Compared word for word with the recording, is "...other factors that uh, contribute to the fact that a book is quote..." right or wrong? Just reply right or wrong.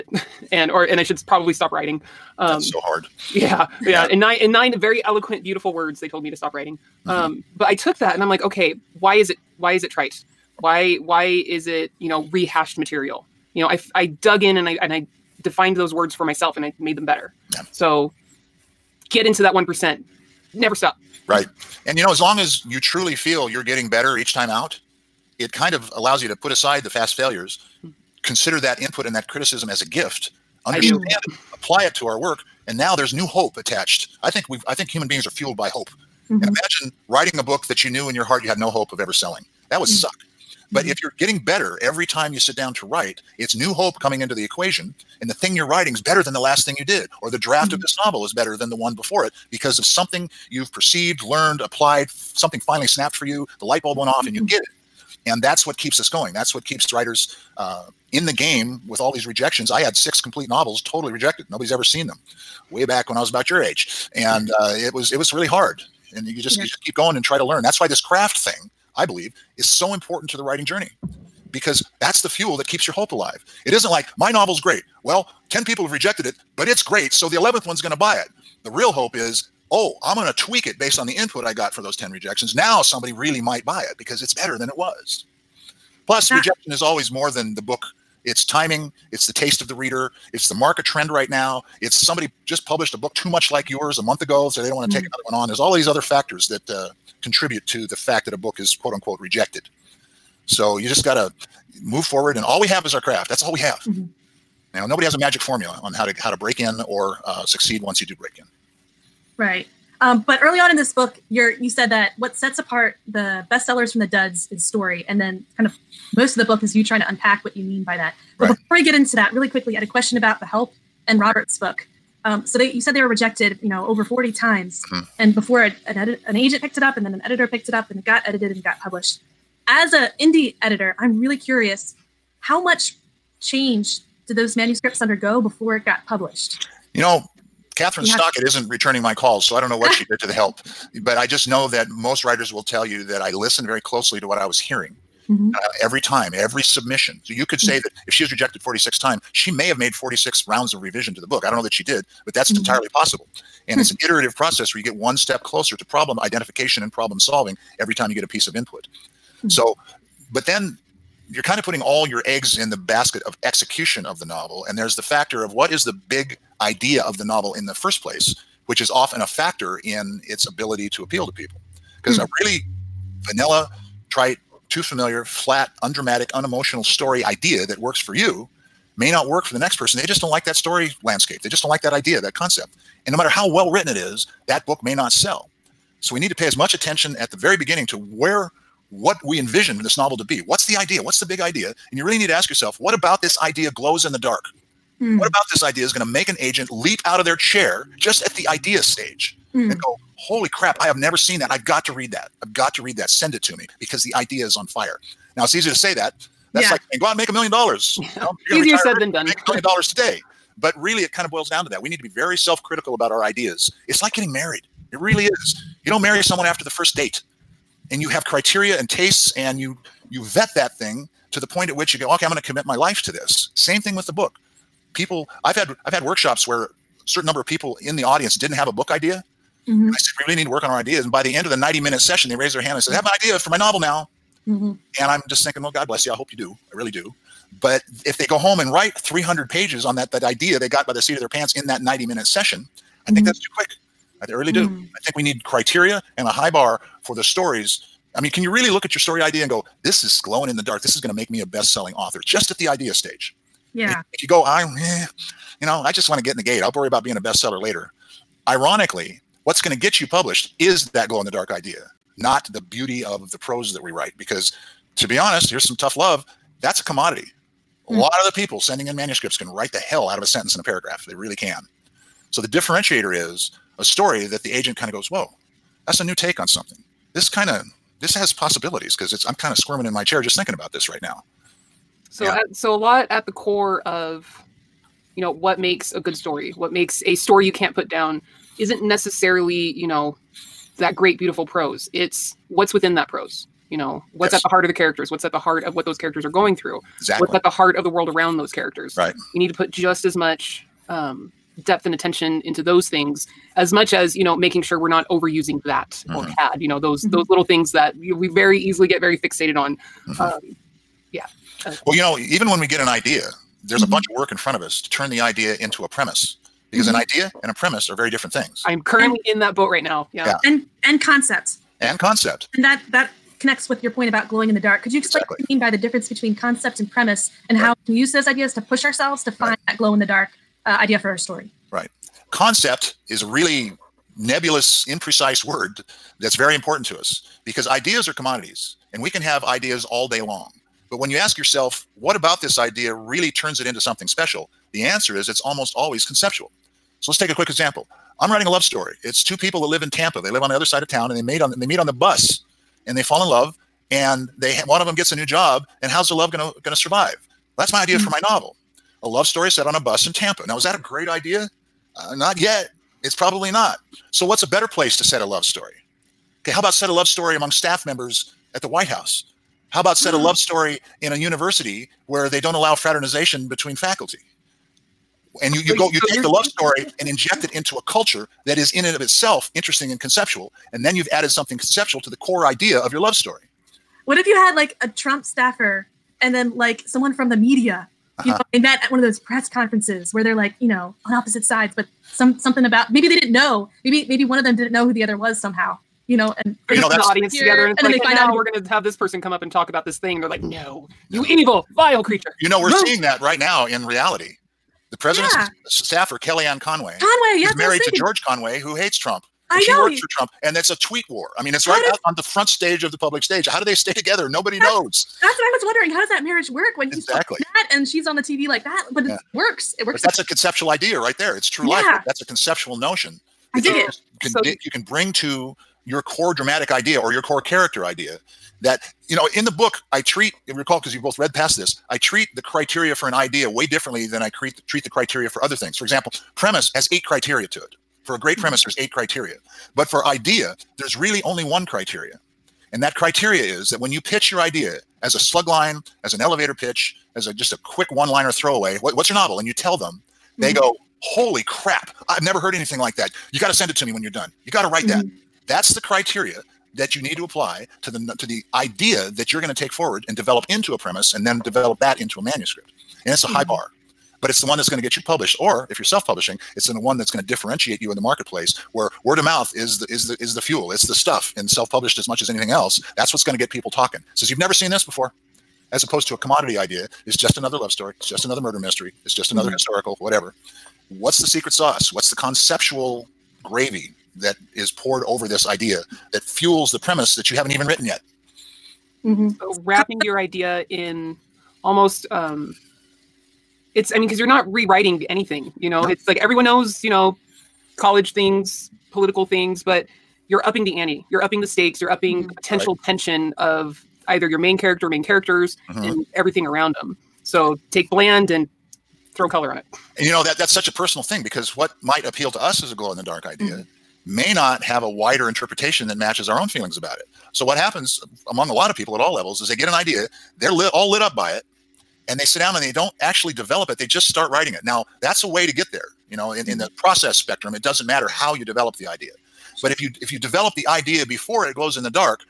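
right.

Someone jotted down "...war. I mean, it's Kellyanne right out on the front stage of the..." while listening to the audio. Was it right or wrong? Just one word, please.
wrong.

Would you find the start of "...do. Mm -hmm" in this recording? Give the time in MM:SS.
04:04.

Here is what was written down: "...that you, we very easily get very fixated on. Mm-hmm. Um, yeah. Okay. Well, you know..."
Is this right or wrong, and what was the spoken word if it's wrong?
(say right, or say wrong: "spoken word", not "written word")
right.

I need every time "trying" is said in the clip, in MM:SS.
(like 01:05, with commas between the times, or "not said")
01:56.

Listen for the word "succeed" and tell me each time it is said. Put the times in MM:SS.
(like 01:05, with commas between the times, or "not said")
01:47.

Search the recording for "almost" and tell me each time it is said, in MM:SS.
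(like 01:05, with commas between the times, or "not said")
05:45, 08:11.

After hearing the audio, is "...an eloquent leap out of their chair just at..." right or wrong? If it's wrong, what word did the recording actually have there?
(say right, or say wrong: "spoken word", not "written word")
wrong: "agent", not "eloquent".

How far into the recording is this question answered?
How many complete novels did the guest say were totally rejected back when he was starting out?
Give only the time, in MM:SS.
00:59.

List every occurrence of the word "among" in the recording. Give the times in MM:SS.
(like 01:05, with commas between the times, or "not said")
06:07, 08:38.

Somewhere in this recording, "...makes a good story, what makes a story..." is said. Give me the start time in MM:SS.
04:45.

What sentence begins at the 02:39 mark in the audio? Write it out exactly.
So, but then you're kind of putting all your eggs in the basket of execution of the novel.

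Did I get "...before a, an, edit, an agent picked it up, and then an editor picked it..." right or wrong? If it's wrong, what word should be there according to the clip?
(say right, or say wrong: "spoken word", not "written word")
right.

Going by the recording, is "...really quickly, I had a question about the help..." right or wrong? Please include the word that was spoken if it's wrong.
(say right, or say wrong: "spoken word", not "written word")
right.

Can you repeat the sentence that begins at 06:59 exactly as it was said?
But that's a conceptual idea right there.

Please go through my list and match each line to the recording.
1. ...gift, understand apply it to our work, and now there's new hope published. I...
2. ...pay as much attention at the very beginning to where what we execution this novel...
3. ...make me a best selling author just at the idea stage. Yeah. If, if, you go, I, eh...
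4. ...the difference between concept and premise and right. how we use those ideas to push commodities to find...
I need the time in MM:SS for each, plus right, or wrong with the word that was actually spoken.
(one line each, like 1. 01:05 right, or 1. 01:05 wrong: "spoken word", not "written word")
1. 00:29 wrong: "attached", not "published"
2. 03:06 wrong: "envision", not "execution"
3. 04:11 right
4. 05:25 wrong: "ourselves", not "commodities".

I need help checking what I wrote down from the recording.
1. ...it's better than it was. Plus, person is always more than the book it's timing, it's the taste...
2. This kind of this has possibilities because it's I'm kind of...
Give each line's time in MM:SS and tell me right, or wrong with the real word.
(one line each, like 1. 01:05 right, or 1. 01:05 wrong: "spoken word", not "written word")
1. 01:24 wrong: "rejection", not "person"
2. 04:37 right.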